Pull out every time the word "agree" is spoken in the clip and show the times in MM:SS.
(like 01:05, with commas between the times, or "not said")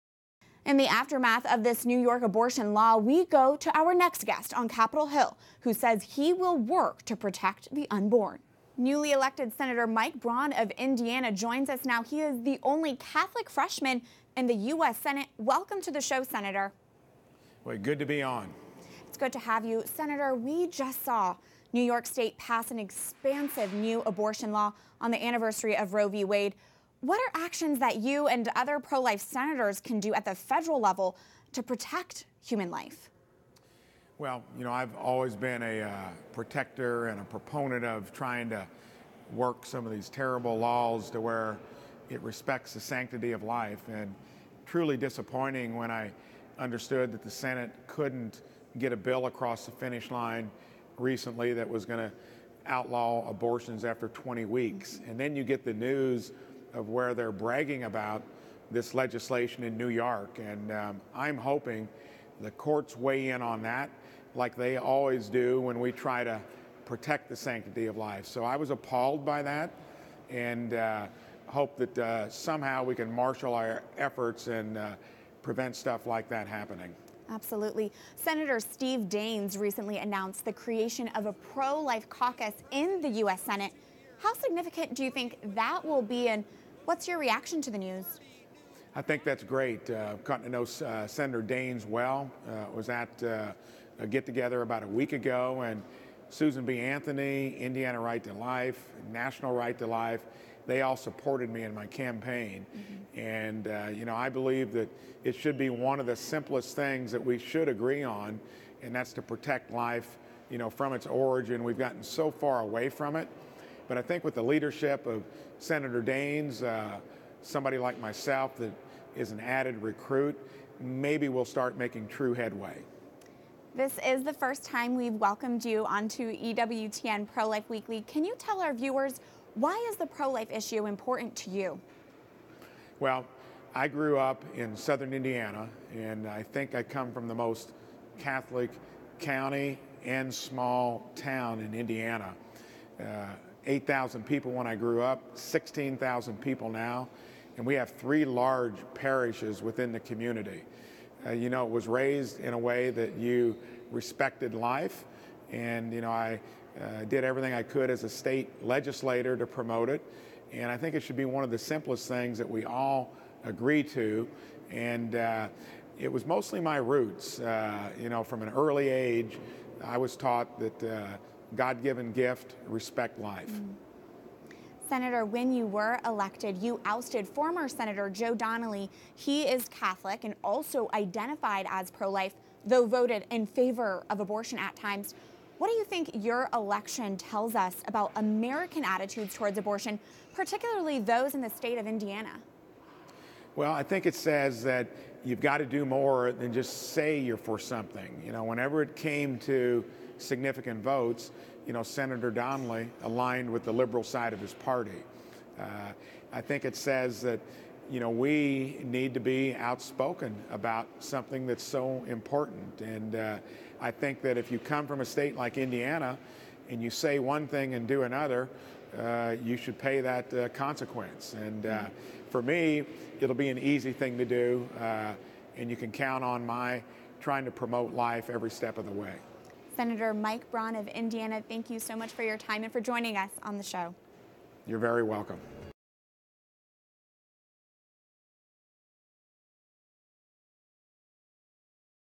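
01:47, 02:43.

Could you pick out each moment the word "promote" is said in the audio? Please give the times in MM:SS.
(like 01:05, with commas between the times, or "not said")
02:39, 03:47.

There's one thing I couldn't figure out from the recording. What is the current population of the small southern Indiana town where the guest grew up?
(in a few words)
16,000.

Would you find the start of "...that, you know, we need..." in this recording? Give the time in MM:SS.
03:27.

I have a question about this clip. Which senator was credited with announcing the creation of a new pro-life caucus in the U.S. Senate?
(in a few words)
Steve Daines.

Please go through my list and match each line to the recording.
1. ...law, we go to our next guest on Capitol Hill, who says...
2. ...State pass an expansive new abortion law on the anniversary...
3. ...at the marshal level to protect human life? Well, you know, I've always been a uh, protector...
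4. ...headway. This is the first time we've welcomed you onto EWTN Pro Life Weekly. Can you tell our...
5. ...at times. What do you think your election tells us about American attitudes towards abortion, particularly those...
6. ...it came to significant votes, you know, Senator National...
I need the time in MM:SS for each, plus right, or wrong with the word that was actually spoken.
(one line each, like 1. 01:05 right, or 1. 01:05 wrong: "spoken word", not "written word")
1. 00:02 right
2. 00:22 right
3. 00:30 wrong: "federal", not "marshal"
4. 02:02 right
5. 03:04 right
6. 03:18 wrong: "Donnelly", not "National".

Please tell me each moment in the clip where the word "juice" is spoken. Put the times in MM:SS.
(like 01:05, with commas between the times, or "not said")
not said.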